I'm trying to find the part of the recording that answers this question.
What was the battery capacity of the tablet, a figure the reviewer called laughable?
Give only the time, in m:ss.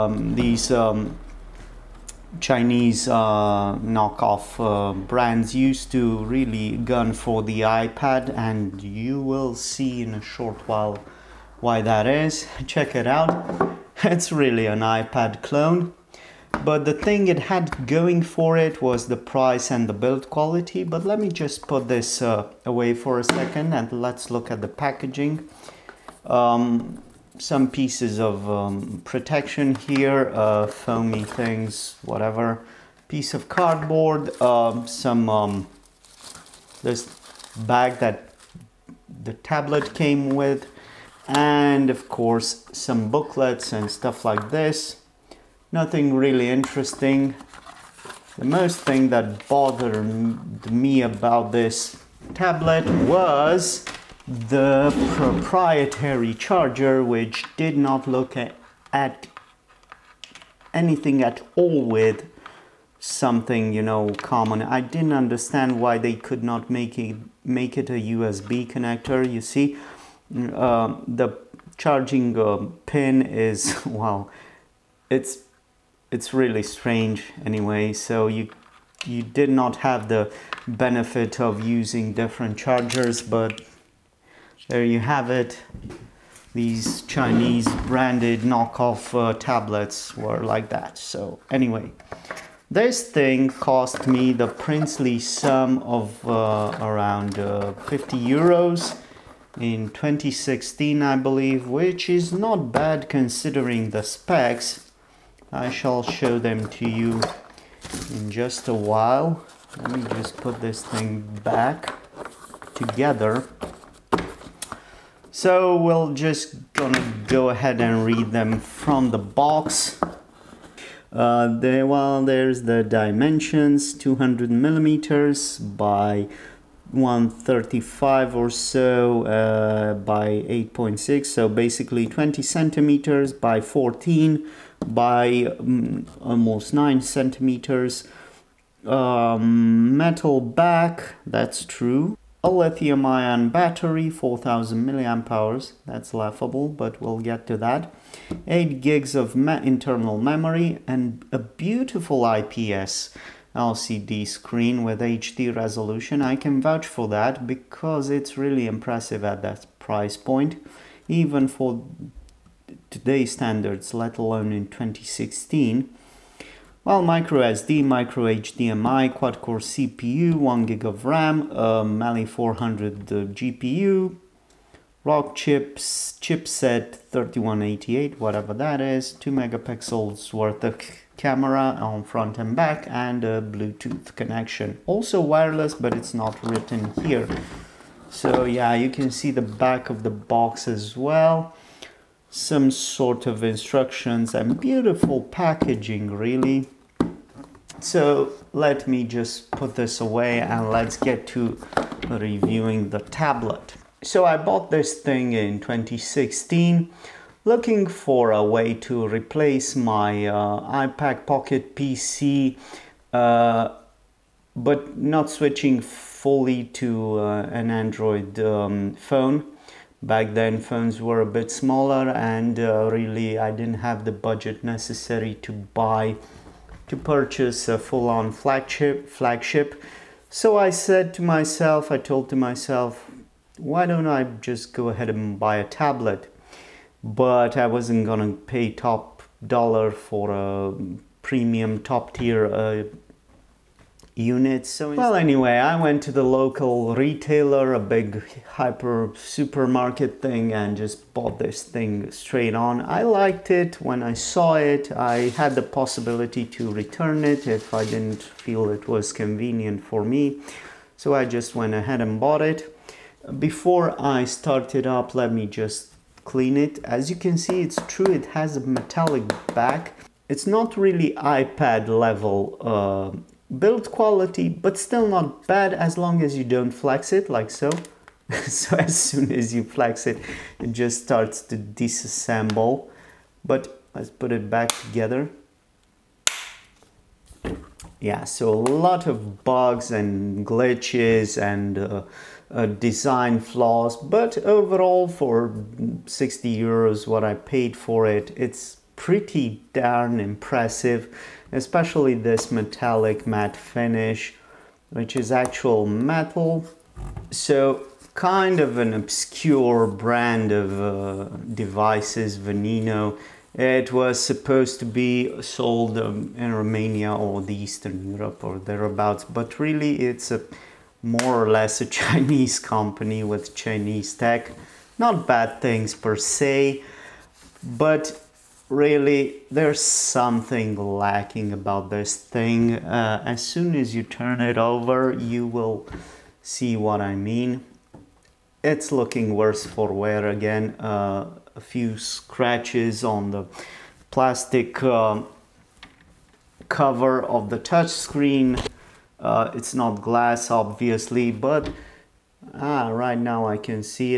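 2:24.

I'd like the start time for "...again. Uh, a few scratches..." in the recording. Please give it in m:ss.
5:40.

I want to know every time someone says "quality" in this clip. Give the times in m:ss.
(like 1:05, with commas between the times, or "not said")
0:20, 4:33.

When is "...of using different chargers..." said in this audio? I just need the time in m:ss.
1:21.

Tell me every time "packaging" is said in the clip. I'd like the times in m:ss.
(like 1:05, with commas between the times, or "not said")
0:24, 3:15.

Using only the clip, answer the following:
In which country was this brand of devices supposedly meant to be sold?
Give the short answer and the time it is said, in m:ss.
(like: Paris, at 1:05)
Romania, at 5:16.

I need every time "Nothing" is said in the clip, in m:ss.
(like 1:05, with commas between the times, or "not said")
0:45.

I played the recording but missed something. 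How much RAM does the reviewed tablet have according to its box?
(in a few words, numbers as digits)
1 gig.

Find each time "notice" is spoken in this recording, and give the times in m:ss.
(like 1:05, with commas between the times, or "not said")
not said.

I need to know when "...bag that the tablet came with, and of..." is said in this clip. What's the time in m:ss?
0:37.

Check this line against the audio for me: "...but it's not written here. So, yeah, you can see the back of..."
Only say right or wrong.
right.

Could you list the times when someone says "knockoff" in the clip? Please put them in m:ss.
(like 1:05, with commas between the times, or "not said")
0:03, 1:28.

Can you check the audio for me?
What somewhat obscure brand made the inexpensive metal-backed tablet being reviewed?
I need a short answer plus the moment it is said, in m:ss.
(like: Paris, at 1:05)
Vonino, at 5:12.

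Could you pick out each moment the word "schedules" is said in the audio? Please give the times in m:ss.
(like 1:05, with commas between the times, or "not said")
not said.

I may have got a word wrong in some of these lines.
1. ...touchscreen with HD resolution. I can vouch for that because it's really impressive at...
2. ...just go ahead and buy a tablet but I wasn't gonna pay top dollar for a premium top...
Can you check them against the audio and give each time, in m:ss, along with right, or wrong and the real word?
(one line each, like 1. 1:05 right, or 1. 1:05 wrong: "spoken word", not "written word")
1. 2:34 wrong: "screen", not "touchscreen"
2. 3:54 right.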